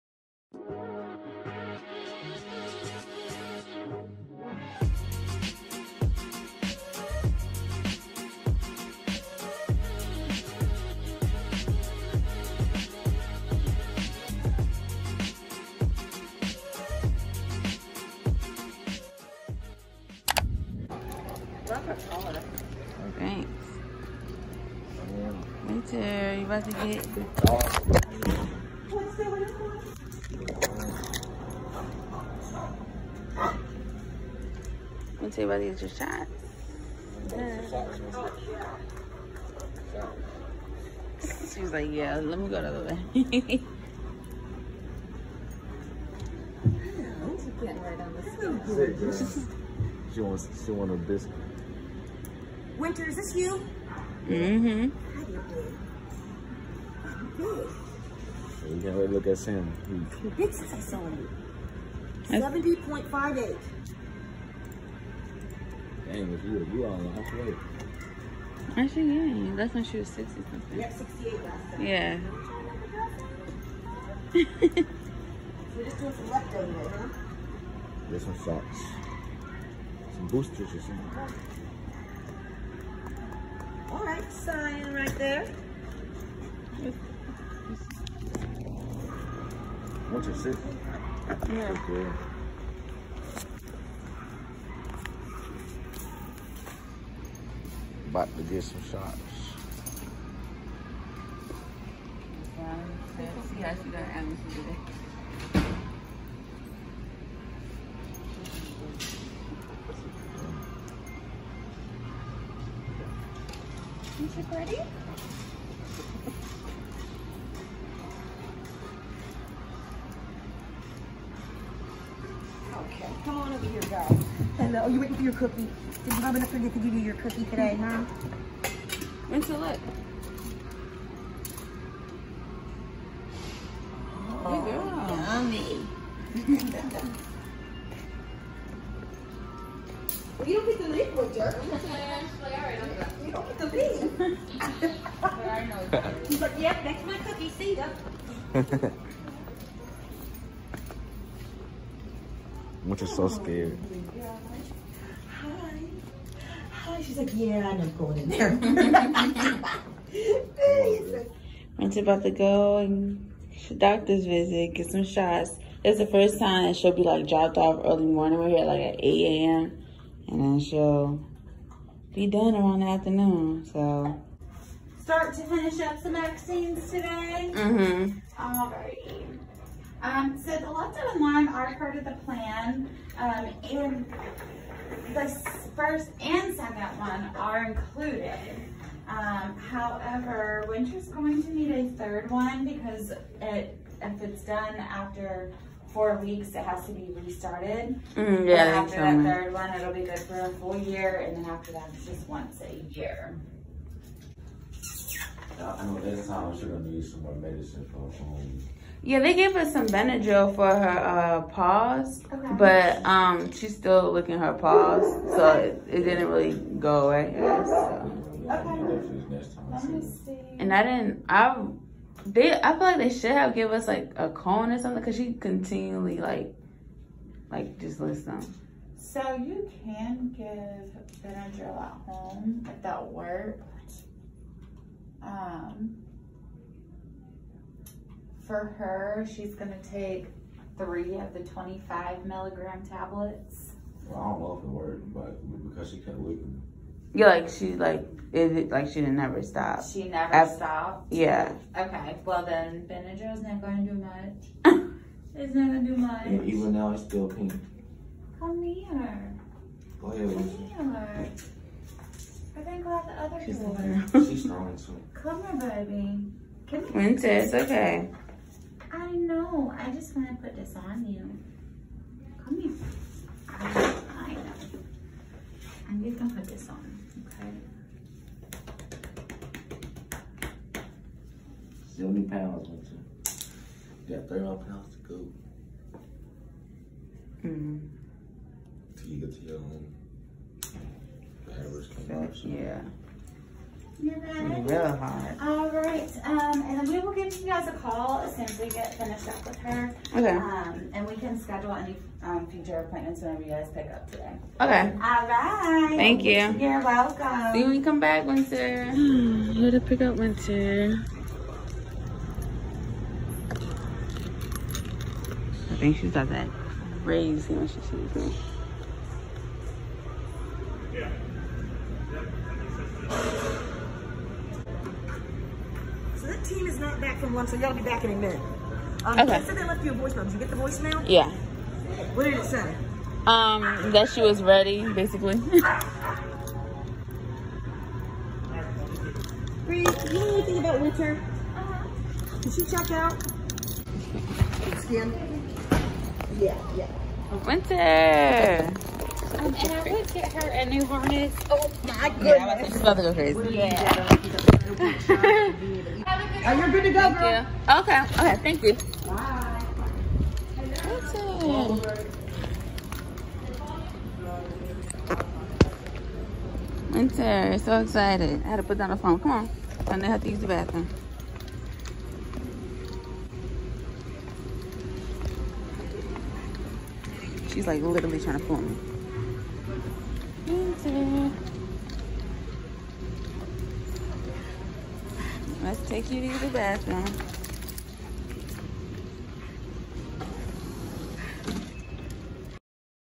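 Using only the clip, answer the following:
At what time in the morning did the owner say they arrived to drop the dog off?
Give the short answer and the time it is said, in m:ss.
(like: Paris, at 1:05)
8 a.m., at 2:48.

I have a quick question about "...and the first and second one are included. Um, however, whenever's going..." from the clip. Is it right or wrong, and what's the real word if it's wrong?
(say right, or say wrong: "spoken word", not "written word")
wrong: "winter", not "whenever".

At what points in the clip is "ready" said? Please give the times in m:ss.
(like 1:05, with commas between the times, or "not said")
1:54, 5:34.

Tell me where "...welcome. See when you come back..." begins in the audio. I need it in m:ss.
5:06.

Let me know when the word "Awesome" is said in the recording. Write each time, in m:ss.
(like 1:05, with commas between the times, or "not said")
6:00.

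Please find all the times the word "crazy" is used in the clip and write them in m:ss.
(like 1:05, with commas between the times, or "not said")
5:17, 5:53.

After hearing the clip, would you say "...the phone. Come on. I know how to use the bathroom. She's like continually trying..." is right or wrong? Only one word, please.
wrong.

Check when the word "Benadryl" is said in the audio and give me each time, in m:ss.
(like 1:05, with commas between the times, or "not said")
3:29, 3:51, 4:12.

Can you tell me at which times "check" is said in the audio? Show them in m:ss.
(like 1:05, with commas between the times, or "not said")
5:42.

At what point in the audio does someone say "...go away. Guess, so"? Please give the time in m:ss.
3:36.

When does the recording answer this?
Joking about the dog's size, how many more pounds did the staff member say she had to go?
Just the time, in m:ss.
4:44.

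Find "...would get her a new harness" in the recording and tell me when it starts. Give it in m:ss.
5:49.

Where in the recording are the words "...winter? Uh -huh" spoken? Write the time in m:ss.
5:40.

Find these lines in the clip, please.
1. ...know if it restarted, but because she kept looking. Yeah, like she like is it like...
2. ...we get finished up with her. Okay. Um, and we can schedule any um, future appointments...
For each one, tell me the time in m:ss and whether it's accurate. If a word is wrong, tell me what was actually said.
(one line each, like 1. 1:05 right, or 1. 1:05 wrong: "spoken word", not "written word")
1. 4:04 wrong: "worked", not "restarted"
2. 4:58 right.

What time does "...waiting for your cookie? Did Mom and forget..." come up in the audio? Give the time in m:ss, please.
2:04.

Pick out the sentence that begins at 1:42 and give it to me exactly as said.
Yeah, how see got Amazon today.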